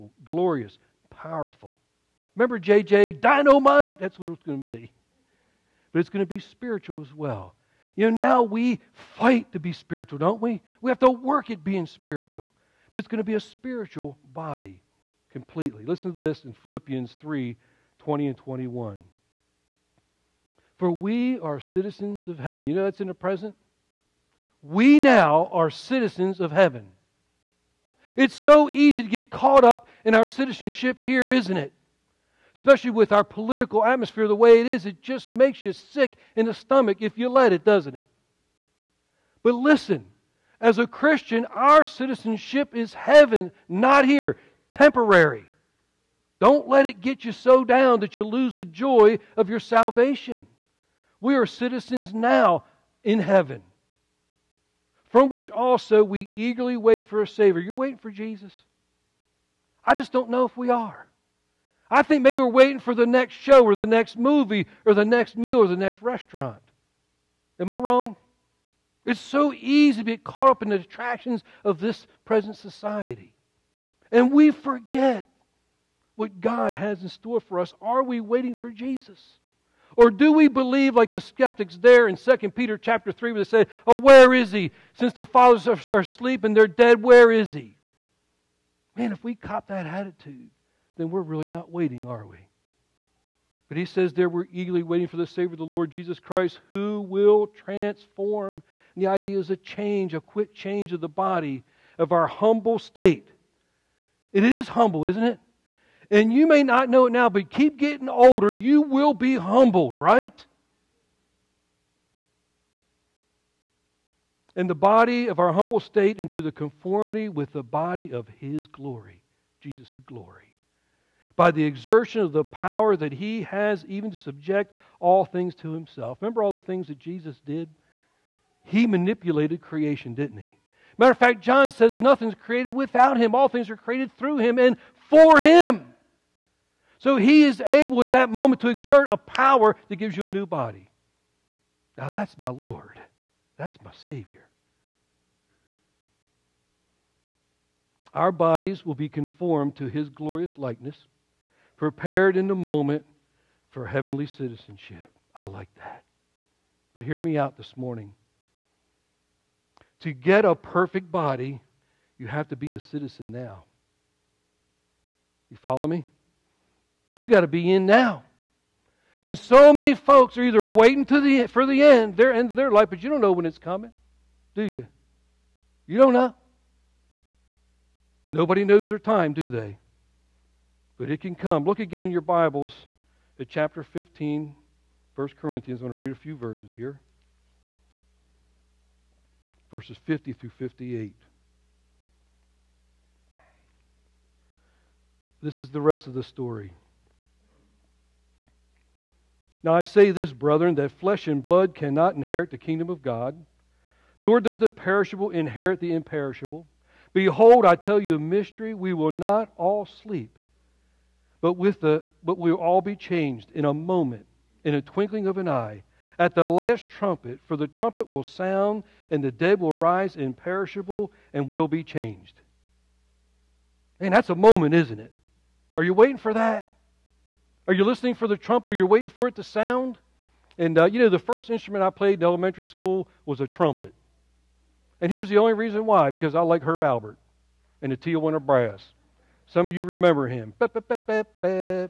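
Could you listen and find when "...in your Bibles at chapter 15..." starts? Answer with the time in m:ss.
3:02.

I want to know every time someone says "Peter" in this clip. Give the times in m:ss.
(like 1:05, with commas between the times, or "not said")
1:22.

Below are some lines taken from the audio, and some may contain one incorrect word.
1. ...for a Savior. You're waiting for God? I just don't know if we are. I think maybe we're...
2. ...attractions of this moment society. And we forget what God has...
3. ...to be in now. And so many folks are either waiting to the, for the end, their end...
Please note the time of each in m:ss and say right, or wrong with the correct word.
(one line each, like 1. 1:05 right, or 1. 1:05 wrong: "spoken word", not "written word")
1. 0:57 wrong: "Jesus", not "God"
2. 1:10 wrong: "present", not "moment"
3. 2:47 right.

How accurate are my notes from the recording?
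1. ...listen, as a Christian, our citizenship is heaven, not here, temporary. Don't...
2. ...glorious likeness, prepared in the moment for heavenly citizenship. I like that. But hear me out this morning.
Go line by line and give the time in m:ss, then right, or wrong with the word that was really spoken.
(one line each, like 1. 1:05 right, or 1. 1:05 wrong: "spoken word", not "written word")
1. 0:39 right
2. 2:30 right.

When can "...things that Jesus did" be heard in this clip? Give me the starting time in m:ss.
2:06.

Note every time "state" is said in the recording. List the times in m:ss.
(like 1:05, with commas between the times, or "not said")
1:42, 1:55.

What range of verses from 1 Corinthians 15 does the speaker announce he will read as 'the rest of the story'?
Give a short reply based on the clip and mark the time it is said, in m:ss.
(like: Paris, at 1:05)
50 through 58, at 3:10.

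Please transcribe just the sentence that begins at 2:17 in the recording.
So he is able at that moment to exert a power that gives you a new body.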